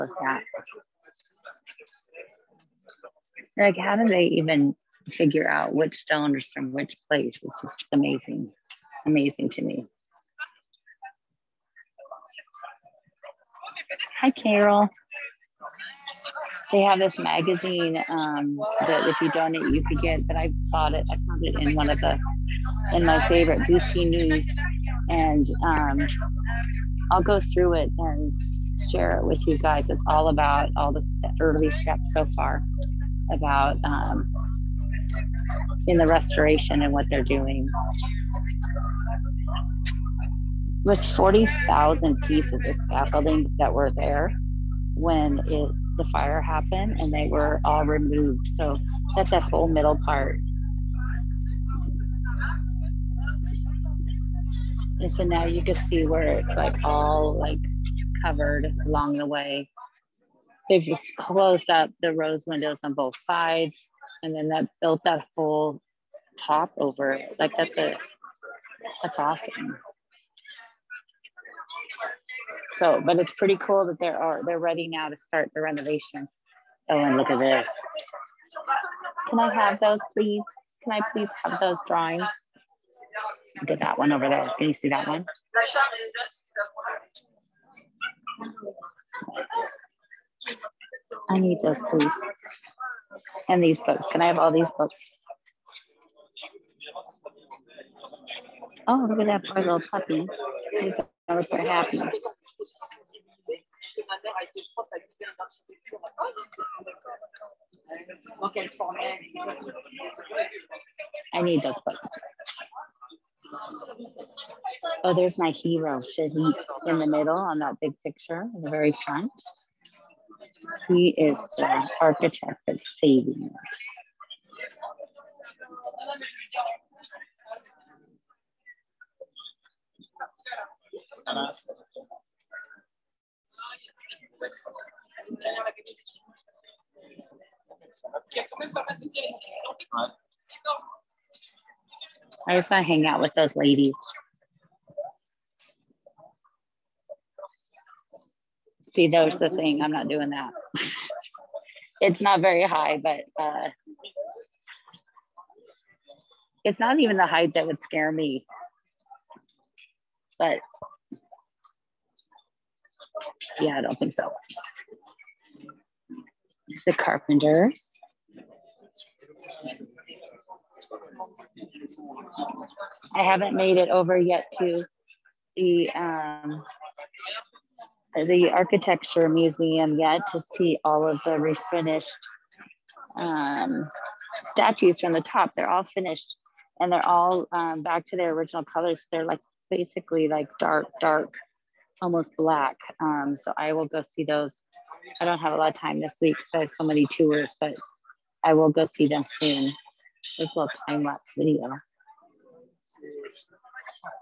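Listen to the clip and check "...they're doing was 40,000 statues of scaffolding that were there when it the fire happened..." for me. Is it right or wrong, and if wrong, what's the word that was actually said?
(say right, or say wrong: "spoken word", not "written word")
wrong: "pieces", not "statues".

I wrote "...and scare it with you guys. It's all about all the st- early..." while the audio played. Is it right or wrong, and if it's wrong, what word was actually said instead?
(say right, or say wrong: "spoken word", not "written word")
wrong: "share", not "scare".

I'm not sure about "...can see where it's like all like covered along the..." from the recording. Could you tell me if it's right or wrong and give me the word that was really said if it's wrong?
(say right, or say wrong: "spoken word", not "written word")
right.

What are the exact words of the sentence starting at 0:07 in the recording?
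It's just amazing, amazing to me.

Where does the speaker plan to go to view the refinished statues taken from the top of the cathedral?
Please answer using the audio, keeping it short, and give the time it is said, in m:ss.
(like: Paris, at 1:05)
architecture museum, at 2:58.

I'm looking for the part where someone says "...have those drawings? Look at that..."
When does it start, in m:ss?
1:21.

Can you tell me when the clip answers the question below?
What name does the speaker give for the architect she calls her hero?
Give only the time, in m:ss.
1:56.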